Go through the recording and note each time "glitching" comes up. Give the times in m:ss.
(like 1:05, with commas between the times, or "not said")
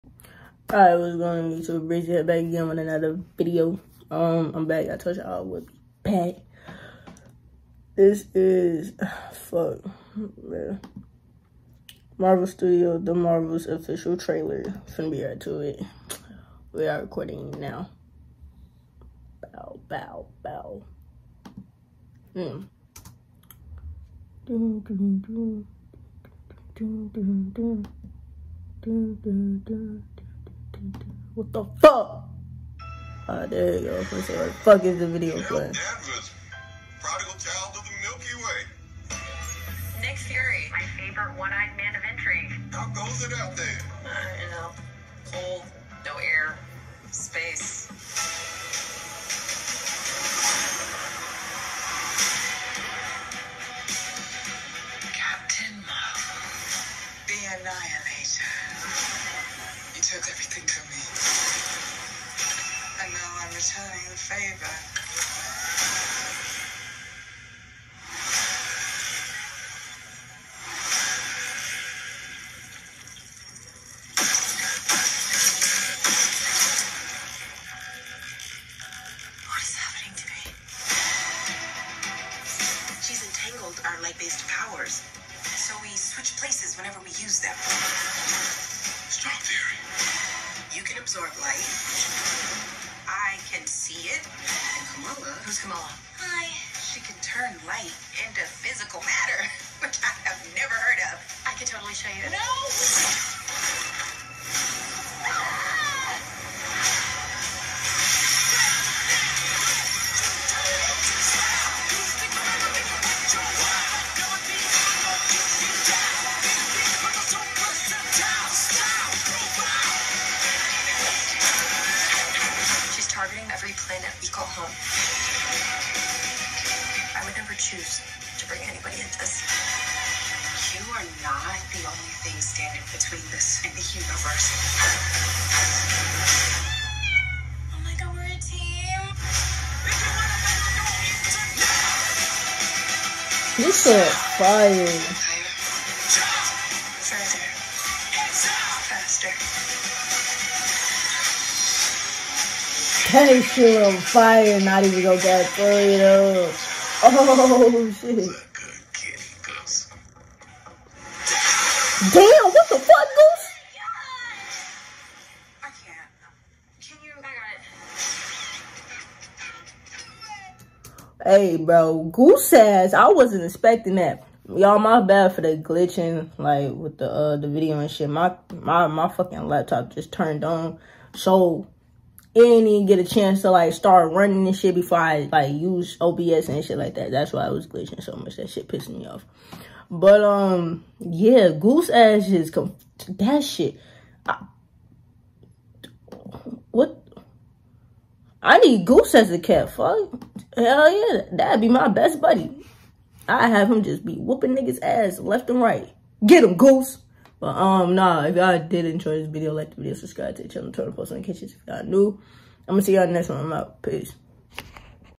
2:55, 3:07.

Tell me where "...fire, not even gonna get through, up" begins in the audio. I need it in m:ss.
2:33.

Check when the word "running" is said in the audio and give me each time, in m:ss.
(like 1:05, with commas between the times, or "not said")
3:04.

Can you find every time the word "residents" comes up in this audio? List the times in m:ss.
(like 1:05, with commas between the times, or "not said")
not said.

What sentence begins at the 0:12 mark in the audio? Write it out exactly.
Marvel Studio, the Marvel's official trailer.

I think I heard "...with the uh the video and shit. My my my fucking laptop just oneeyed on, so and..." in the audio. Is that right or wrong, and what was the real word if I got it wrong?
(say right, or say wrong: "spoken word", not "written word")
wrong: "turned", not "oneeyed".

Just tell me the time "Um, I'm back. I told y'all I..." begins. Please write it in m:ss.
0:04.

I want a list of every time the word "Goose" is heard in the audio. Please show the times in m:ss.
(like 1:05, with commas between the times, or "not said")
2:43, 2:52, 3:11, 3:18, 3:26.